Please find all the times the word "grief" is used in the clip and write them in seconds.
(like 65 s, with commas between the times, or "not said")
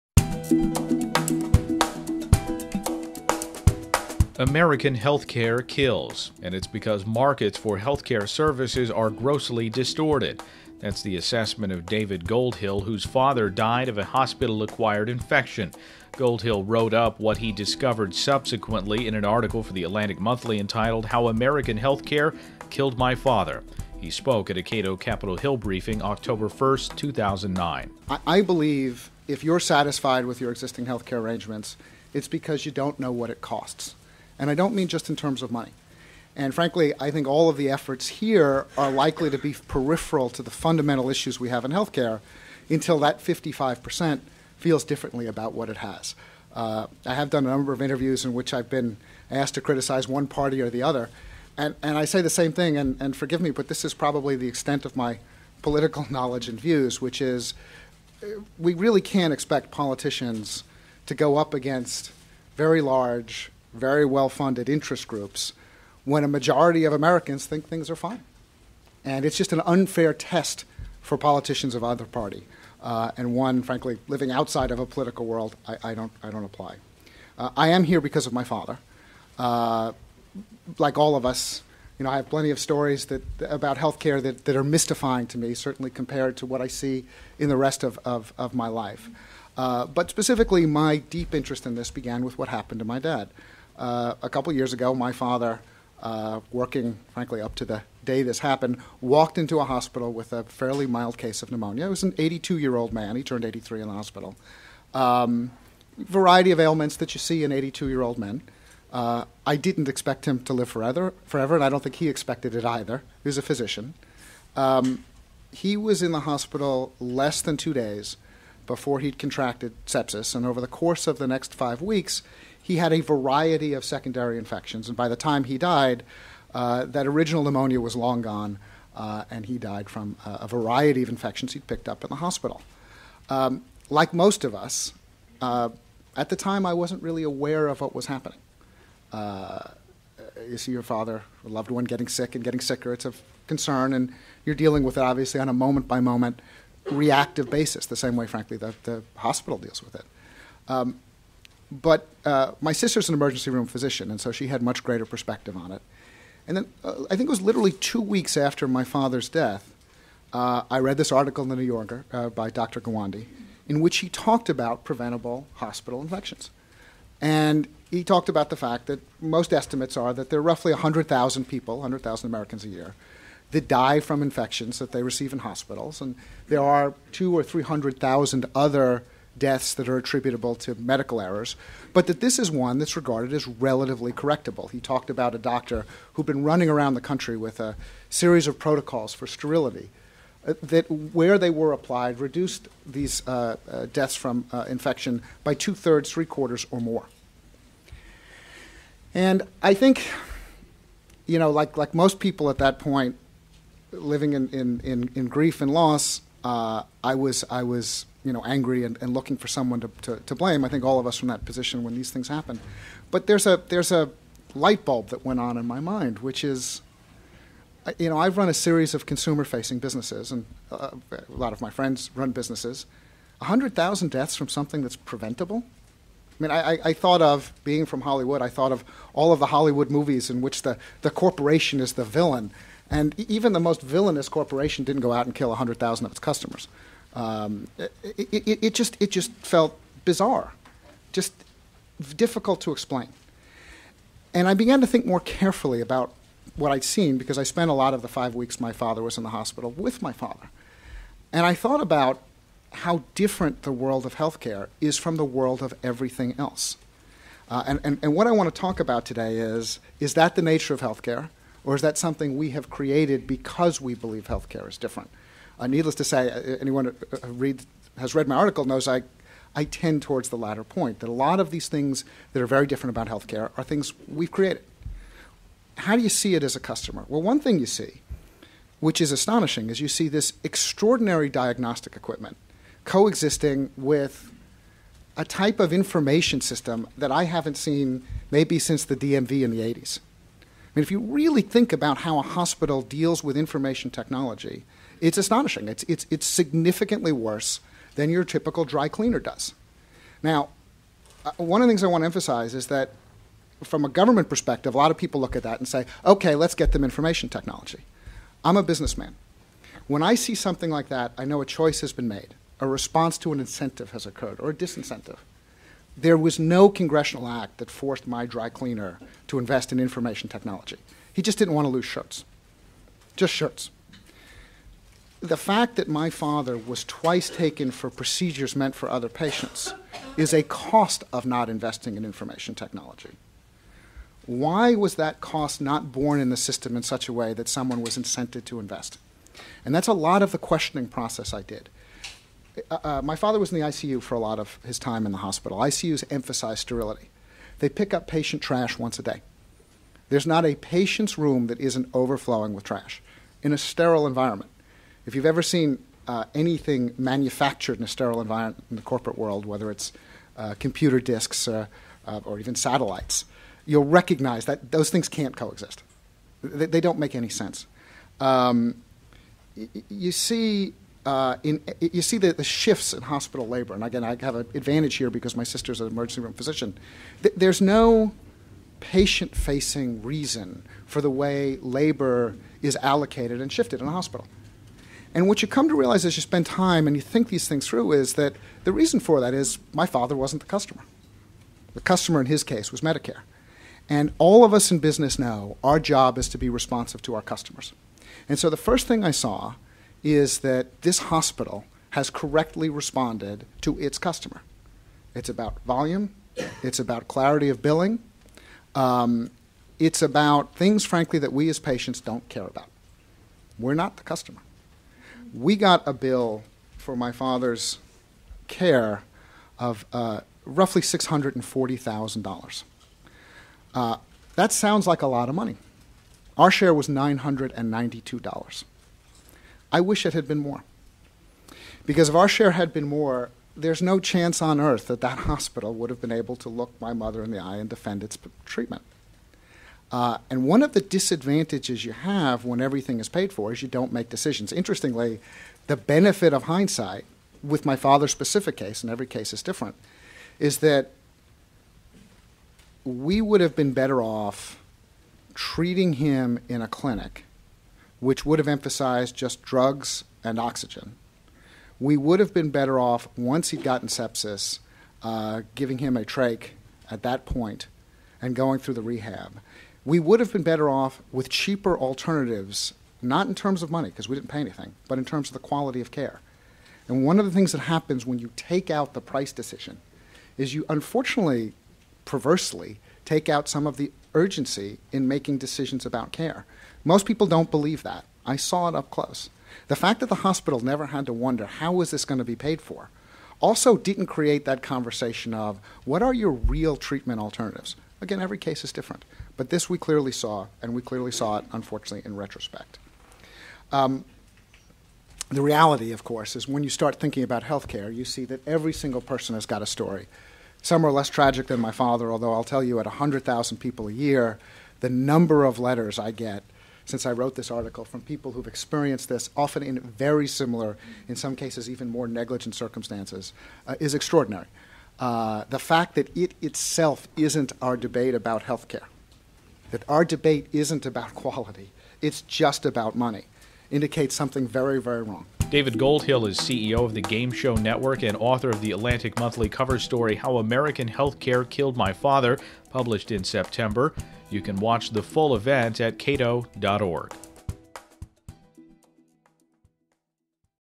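205 s.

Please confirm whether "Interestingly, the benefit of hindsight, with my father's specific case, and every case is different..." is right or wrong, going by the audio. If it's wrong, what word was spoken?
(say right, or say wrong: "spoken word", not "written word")
right.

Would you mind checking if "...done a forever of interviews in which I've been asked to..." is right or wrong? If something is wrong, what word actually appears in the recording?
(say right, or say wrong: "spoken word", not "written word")
wrong: "number", not "forever".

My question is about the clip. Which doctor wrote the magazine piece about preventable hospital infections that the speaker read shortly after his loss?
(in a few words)
Dr. Gawande.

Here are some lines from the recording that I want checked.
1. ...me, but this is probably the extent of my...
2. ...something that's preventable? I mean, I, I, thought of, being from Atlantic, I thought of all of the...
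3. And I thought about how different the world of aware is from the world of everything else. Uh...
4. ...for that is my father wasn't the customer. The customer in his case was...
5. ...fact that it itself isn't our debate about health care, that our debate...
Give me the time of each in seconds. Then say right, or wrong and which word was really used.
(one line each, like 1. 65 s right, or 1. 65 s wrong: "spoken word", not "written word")
1. 53 s right
2. 224 s wrong: "Hollywood", not "Atlantic"
3. 251 s wrong: "healthcare", not "aware"
4. 388 s right
5. 525 s right.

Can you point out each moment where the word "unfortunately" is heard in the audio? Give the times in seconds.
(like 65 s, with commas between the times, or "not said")
480 s, 501 s.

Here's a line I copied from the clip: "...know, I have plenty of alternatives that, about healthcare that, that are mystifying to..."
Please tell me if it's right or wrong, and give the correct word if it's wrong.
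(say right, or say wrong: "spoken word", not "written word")
wrong: "stories", not "alternatives".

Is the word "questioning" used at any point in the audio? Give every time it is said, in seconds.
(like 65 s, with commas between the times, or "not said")
340 s.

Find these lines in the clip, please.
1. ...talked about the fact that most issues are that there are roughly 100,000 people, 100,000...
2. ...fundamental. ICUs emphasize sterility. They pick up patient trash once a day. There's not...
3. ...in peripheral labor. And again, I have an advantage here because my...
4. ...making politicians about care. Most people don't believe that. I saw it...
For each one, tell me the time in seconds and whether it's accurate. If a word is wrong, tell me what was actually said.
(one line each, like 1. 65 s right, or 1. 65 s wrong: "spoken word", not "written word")
1. 168 s wrong: "estimates", not "issues"
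2. 345 s wrong: "hospital", not "fundamental"
3. 372 s wrong: "hospital", not "peripheral"
4. 485 s wrong: "decisions", not "politicians".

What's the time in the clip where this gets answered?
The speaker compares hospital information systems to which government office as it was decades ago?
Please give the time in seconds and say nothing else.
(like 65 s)
288 s.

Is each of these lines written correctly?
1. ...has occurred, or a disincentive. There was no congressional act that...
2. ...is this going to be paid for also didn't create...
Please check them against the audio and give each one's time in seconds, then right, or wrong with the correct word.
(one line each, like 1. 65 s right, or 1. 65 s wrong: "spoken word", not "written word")
1. 313 s right
2. 491 s right.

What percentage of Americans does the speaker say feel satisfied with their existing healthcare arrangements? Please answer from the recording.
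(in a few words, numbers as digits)
55%.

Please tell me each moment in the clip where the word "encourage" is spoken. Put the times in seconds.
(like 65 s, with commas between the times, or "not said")
not said.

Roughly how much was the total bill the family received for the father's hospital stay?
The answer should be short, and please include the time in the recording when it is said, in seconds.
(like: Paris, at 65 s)
$640,000, at 420 s.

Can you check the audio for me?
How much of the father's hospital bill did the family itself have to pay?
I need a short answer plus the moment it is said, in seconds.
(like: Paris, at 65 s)
$992, at 426 s.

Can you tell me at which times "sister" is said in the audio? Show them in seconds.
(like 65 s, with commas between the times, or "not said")
152 s, 375 s.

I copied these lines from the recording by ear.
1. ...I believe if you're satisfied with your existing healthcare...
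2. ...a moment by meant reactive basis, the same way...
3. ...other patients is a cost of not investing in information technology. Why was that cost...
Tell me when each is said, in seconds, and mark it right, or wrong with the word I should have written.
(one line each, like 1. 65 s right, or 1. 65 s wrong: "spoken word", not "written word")
1. 28 s right
2. 145 s wrong: "moment", not "meant"
3. 328 s right.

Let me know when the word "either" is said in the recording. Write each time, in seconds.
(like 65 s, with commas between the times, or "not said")
71 s, 112 s.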